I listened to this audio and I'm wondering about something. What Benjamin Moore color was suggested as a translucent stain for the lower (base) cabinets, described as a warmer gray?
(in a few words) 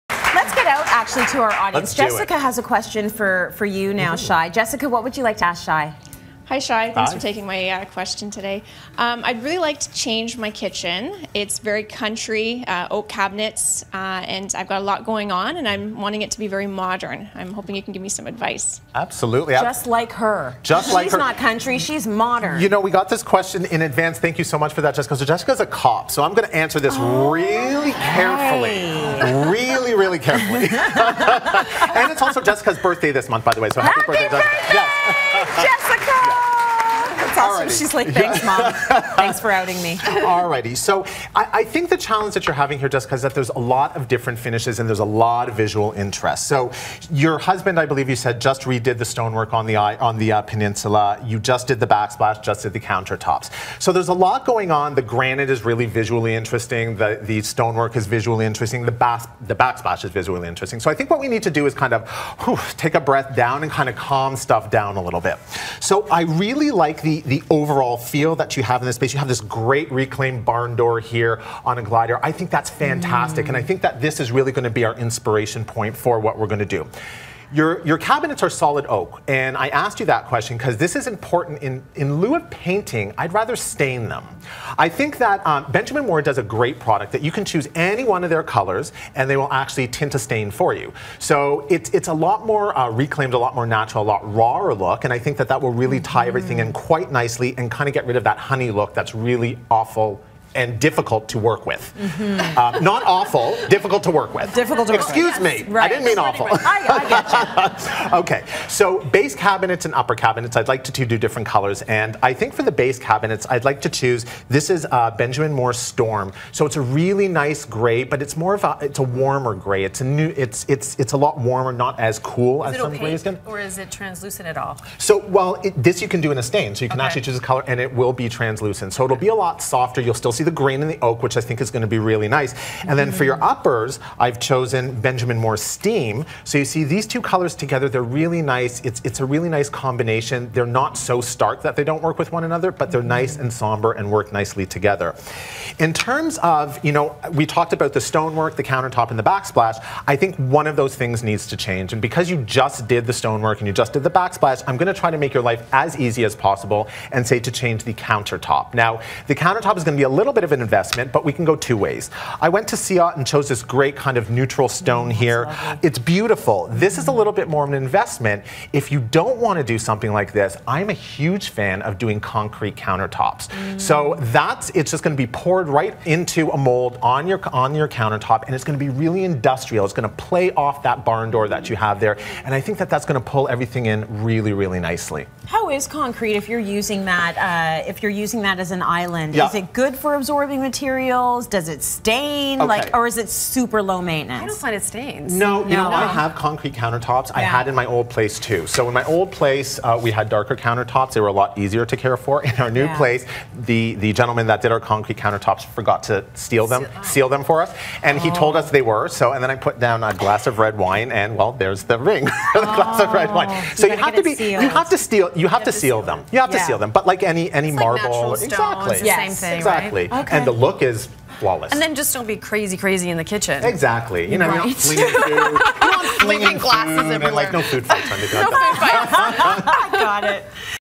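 Storm.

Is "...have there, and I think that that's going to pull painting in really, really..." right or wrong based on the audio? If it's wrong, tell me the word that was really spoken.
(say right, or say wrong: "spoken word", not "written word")
wrong: "everything", not "painting".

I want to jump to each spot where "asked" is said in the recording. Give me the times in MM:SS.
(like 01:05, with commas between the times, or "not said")
01:19.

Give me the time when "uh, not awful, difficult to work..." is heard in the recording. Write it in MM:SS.
01:42.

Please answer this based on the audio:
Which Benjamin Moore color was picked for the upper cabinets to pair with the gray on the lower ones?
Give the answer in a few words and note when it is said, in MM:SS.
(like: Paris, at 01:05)
Steam, at 02:14.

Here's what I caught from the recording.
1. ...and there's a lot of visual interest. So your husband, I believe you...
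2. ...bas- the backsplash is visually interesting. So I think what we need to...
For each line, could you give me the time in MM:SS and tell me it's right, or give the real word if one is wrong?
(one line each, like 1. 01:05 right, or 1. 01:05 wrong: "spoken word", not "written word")
1. 00:44 right
2. 00:58 right.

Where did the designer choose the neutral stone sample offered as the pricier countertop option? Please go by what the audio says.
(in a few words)
Ciot.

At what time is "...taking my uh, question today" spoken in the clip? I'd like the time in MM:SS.
00:07.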